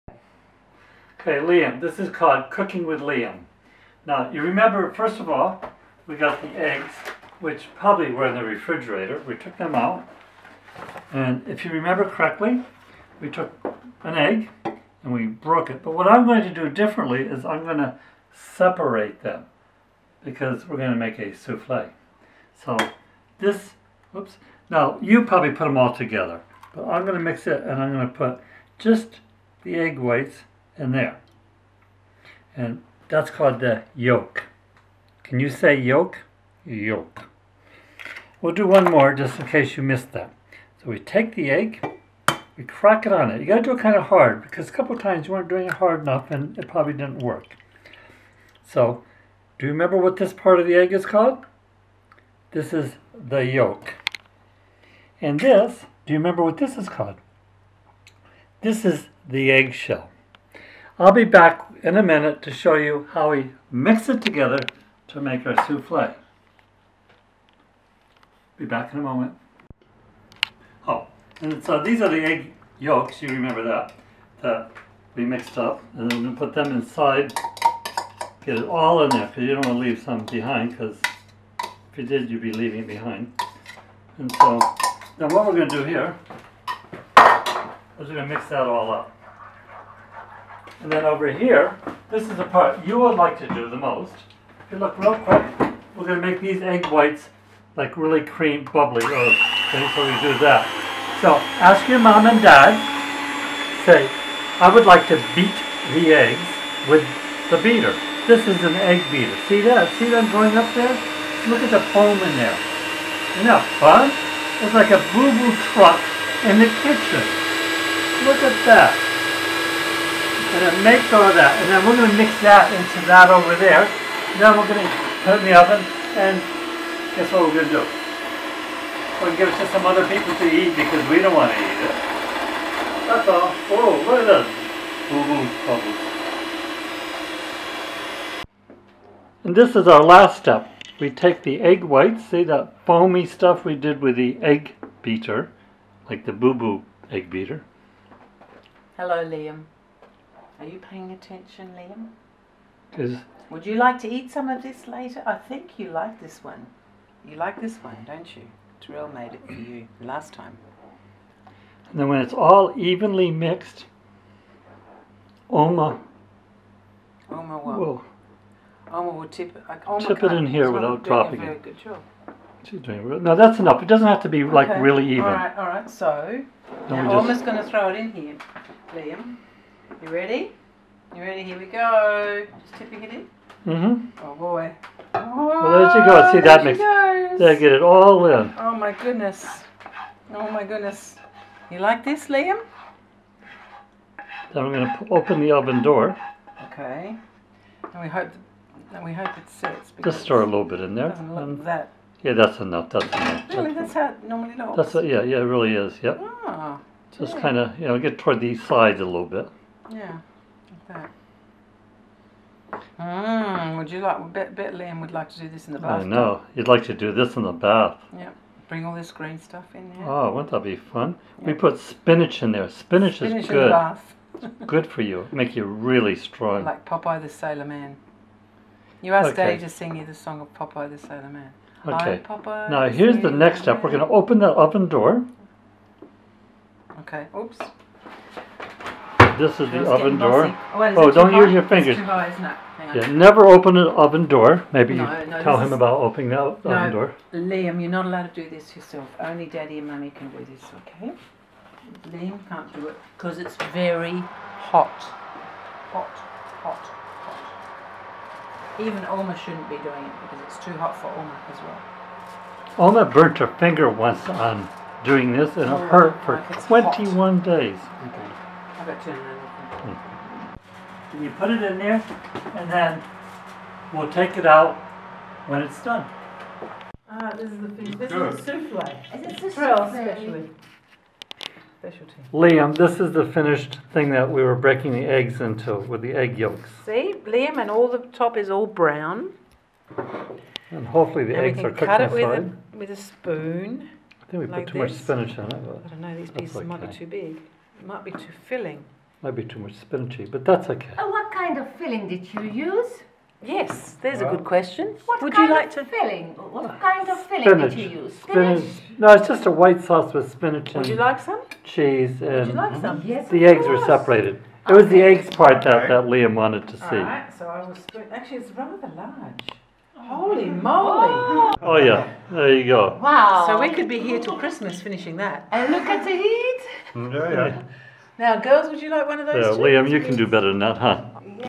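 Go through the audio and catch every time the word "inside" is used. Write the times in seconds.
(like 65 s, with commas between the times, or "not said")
76 s, 291 s.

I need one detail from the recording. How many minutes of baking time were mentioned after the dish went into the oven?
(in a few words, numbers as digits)
10.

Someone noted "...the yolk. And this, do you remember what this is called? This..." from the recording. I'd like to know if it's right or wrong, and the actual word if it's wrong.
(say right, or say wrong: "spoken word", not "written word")
right.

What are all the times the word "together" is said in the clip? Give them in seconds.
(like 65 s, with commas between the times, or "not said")
25 s, 64 s.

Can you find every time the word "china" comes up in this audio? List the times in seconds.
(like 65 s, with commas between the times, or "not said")
not said.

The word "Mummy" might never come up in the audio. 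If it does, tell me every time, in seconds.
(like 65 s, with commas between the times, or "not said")
249 s.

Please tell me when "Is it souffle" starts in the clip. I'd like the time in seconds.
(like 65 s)
279 s.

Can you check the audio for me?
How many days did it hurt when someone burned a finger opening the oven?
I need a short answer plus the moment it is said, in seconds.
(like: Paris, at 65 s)
21, at 266 s.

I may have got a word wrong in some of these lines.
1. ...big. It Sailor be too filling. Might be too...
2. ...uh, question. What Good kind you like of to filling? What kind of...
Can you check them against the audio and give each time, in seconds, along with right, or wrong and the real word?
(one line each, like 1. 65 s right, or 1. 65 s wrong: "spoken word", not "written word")
1. 297 s wrong: "Might", not "Sailor"
2. 304 s wrong: "Would", not "Good".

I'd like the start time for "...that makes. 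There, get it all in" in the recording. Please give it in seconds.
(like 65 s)
186 s.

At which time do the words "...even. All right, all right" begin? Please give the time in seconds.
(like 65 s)
175 s.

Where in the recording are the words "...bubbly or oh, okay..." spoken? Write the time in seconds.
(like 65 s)
98 s.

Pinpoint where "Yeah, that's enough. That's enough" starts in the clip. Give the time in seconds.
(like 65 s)
202 s.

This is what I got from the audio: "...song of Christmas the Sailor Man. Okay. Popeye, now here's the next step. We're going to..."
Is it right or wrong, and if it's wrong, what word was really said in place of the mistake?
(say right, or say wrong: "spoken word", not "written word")
wrong: "Popeye", not "Christmas".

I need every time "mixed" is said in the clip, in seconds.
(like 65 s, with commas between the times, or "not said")
75 s, 163 s.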